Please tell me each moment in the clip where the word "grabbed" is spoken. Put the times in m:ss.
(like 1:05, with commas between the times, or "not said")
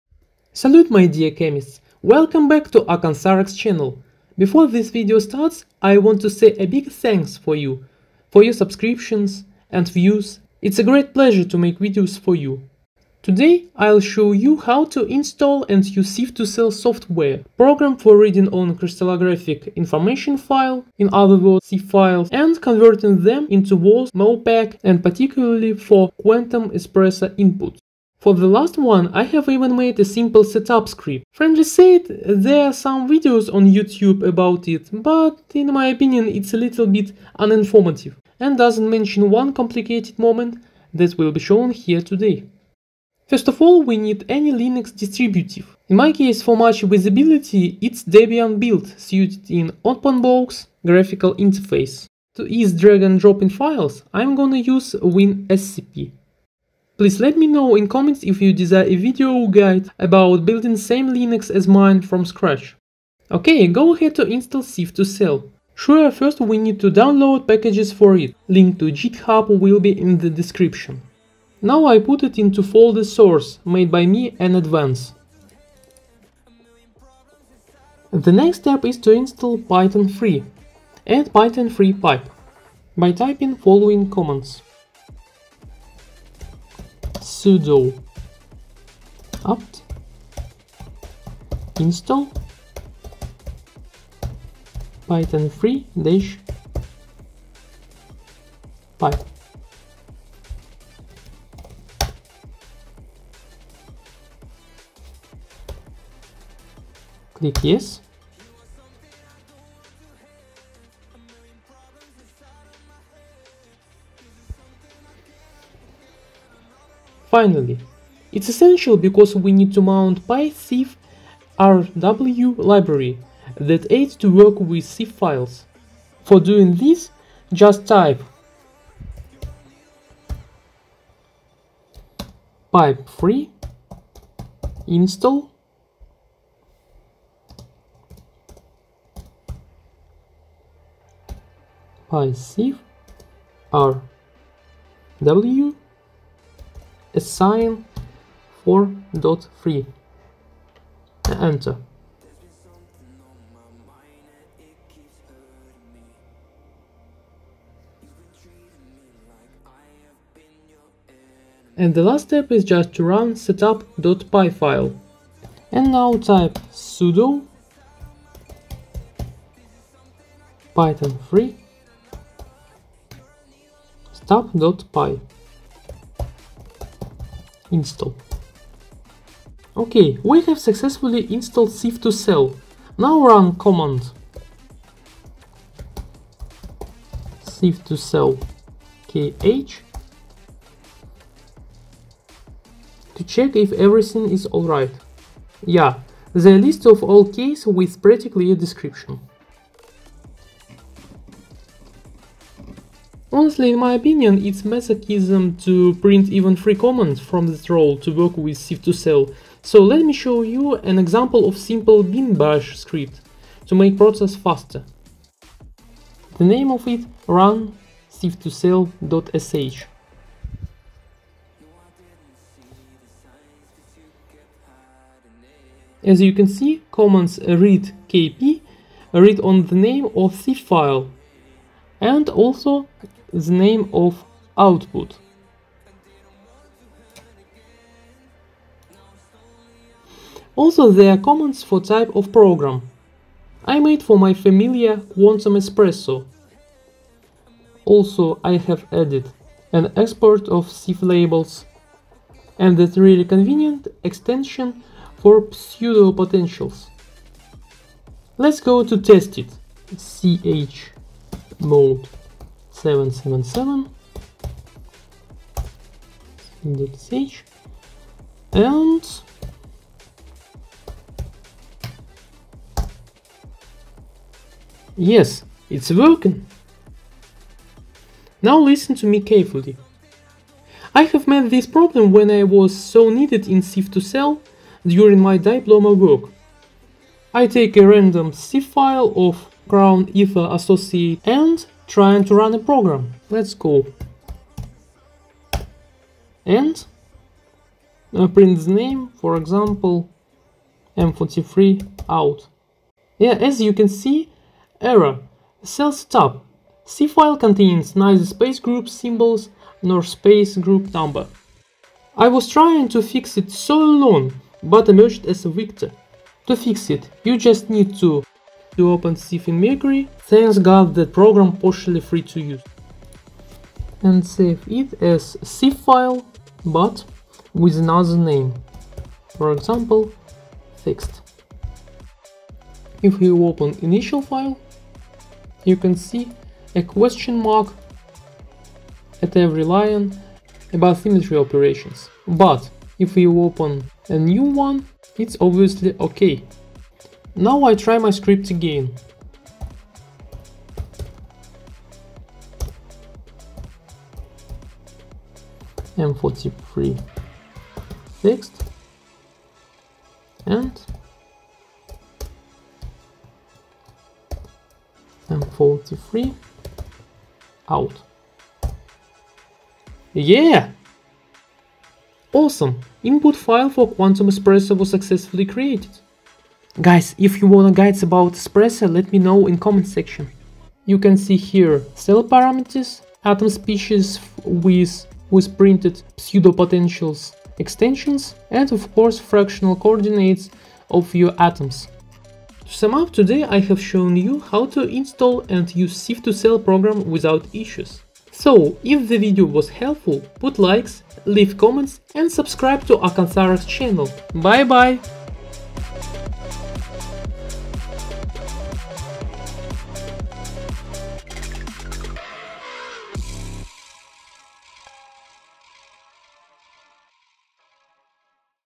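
not said.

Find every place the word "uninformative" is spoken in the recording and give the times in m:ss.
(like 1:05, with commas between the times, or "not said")
0:37.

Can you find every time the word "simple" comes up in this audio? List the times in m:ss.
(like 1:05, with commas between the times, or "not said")
0:30, 3:31.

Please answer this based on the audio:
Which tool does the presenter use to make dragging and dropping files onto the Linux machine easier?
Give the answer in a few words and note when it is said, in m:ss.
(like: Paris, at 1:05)
WinSCP, at 0:55.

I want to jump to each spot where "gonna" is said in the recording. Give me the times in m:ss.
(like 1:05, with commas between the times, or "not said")
0:54.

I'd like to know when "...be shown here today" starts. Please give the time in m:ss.
0:41.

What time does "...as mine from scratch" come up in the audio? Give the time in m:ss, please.
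1:01.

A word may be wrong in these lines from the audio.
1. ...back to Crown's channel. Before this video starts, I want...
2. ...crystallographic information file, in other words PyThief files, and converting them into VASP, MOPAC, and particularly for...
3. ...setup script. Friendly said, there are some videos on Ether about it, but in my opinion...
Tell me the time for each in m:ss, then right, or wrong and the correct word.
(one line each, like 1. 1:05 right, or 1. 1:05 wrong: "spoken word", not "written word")
1. 0:02 wrong: "AcanthareX", not "Crown"
2. 0:18 wrong: "CIF", not "PyThief"
3. 0:30 wrong: "YouTube", not "Ether".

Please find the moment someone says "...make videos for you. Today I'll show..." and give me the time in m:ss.
0:11.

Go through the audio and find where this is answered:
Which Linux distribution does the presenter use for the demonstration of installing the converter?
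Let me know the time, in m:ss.
0:48.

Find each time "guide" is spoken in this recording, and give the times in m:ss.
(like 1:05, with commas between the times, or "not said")
0:59, 6:17.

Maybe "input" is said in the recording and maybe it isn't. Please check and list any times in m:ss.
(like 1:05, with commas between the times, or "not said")
0:27, 6:13.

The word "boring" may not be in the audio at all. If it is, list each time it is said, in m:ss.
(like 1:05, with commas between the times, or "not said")
not said.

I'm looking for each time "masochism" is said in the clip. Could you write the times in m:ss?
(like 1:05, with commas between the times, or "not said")
3:24.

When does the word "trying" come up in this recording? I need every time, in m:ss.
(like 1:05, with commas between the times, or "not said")
4:51, 5:12.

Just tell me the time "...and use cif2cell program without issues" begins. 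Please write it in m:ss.
6:35.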